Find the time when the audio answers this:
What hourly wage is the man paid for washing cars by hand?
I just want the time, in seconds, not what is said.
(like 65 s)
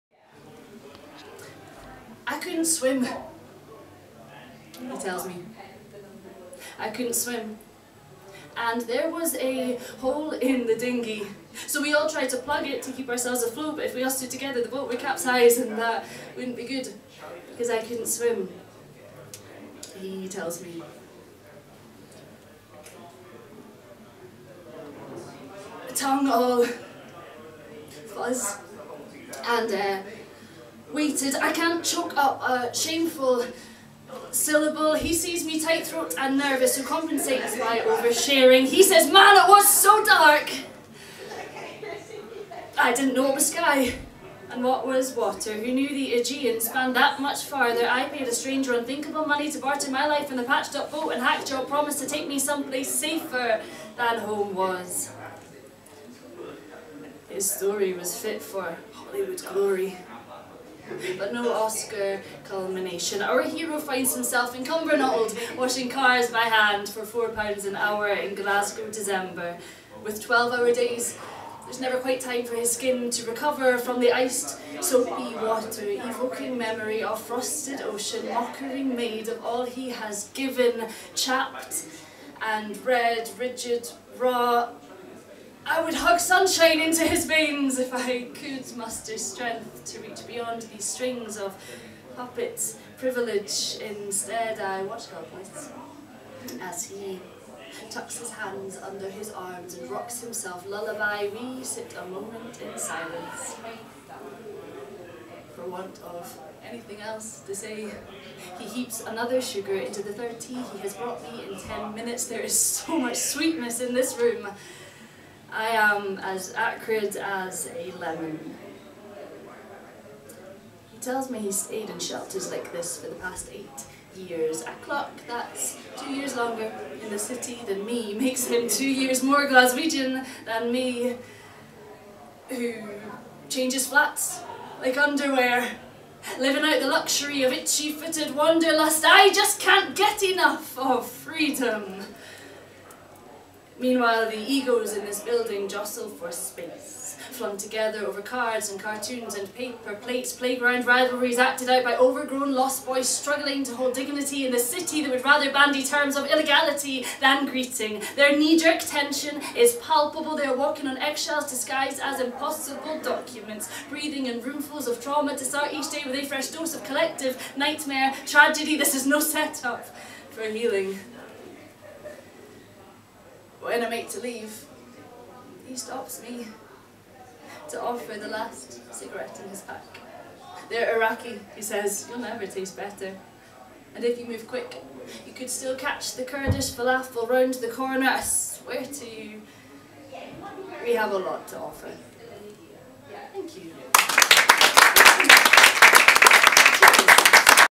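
67 s.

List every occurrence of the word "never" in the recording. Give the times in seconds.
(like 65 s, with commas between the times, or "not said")
71 s, 182 s.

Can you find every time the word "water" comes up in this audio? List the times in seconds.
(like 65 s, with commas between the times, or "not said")
45 s, 75 s.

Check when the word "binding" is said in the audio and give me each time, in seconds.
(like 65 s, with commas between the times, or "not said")
not said.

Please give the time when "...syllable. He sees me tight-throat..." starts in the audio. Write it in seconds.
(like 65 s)
34 s.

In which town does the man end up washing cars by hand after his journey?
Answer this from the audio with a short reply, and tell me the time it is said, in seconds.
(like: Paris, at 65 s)
Cumbernauld, at 64 s.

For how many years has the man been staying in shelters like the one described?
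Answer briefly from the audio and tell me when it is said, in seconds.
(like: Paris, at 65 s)
8, at 123 s.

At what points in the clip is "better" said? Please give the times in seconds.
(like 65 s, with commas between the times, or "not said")
182 s.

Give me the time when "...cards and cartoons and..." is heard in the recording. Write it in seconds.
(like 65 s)
148 s.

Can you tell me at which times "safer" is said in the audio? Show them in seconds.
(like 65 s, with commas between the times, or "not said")
52 s.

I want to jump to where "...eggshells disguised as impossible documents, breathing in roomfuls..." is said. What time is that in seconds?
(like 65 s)
160 s.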